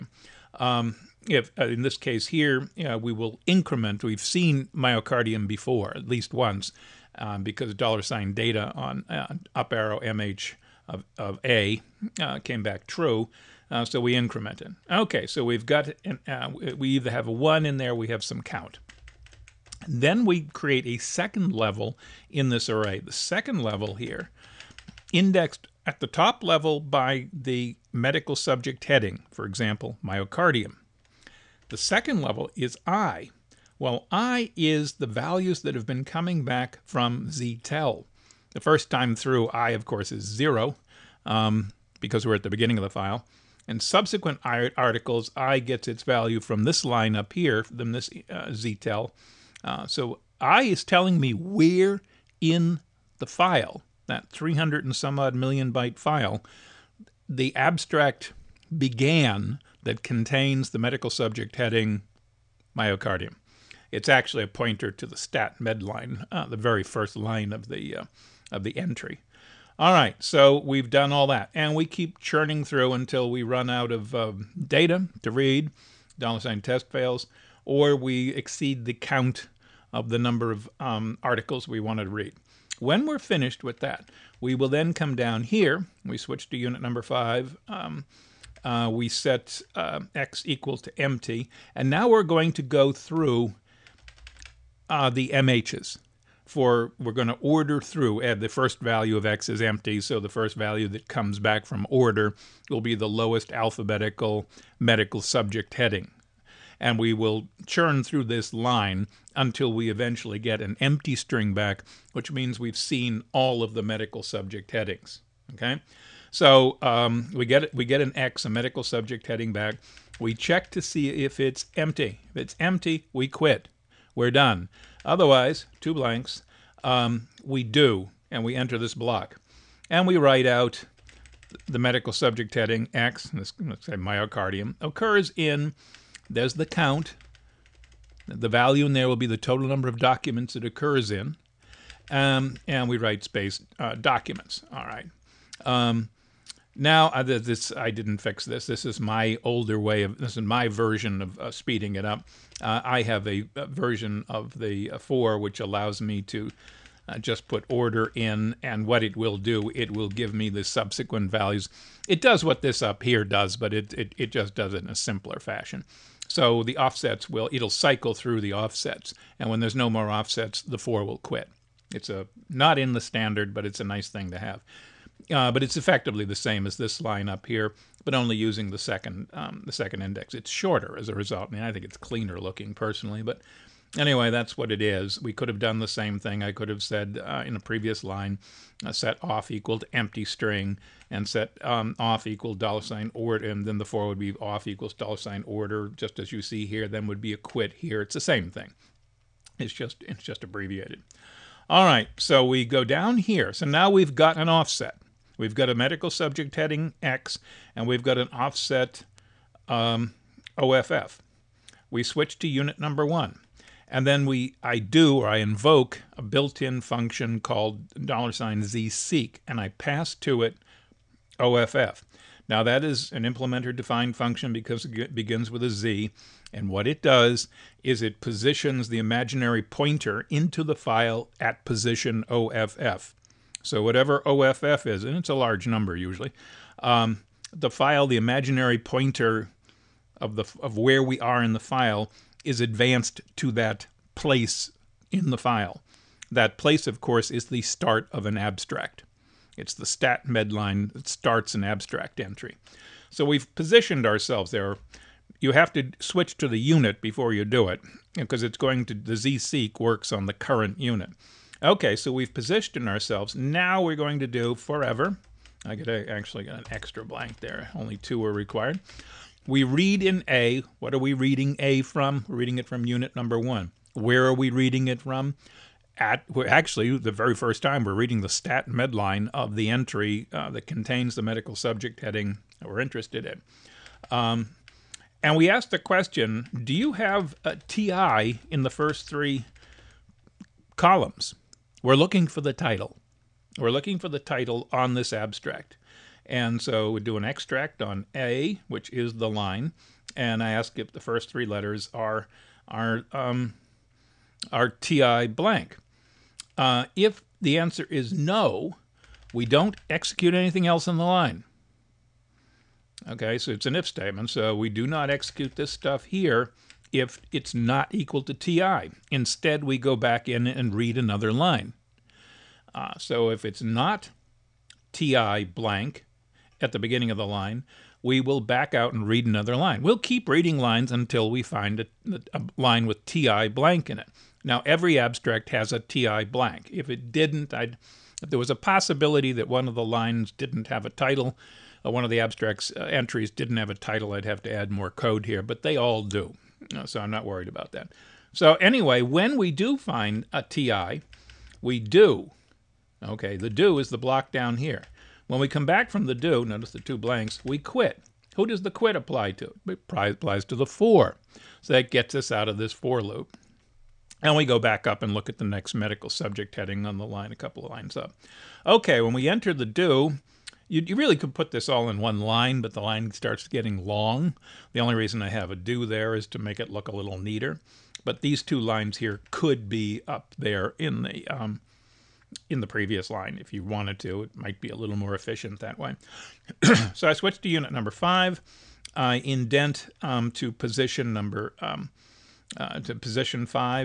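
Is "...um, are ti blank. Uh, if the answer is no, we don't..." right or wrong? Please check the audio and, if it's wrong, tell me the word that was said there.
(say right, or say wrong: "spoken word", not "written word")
right.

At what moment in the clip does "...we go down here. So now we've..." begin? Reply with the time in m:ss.
3:22.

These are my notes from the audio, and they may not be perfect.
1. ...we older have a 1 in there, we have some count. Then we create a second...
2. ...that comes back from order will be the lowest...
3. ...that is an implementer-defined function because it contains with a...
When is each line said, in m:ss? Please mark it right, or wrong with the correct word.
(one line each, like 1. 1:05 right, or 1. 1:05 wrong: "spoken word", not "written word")
1. 0:16 wrong: "either", not "older"
2. 1:40 right
3. 3:42 wrong: "begins", not "contains".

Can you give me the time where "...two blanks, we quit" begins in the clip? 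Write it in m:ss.
5:56.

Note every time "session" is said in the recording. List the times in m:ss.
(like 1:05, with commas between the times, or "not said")
not said.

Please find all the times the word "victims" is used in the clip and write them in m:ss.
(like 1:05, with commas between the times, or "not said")
not said.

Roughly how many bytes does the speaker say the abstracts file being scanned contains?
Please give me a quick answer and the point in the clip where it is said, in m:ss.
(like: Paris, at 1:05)
300 and some odd million bytes, at 0:54.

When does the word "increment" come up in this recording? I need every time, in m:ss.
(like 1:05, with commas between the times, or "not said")
0:03, 0:14.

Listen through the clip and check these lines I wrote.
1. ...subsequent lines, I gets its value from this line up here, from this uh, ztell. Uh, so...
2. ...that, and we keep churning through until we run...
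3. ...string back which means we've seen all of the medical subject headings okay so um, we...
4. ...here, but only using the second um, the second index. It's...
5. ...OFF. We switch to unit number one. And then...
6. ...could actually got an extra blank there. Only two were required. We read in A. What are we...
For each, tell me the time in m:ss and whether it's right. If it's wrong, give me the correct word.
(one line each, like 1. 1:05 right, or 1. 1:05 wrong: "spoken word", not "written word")
1. 0:43 wrong: "articles", not "lines"
2. 1:11 right
3. 1:51 right
4. 2:57 right
5. 3:30 right
6. 4:25 right.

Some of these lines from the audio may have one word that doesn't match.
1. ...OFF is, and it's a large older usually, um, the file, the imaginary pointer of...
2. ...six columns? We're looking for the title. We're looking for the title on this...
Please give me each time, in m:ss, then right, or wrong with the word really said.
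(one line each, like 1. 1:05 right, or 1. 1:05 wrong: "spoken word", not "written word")
1. 3:54 wrong: "number", not "older"
2. 4:49 wrong: "three", not "six".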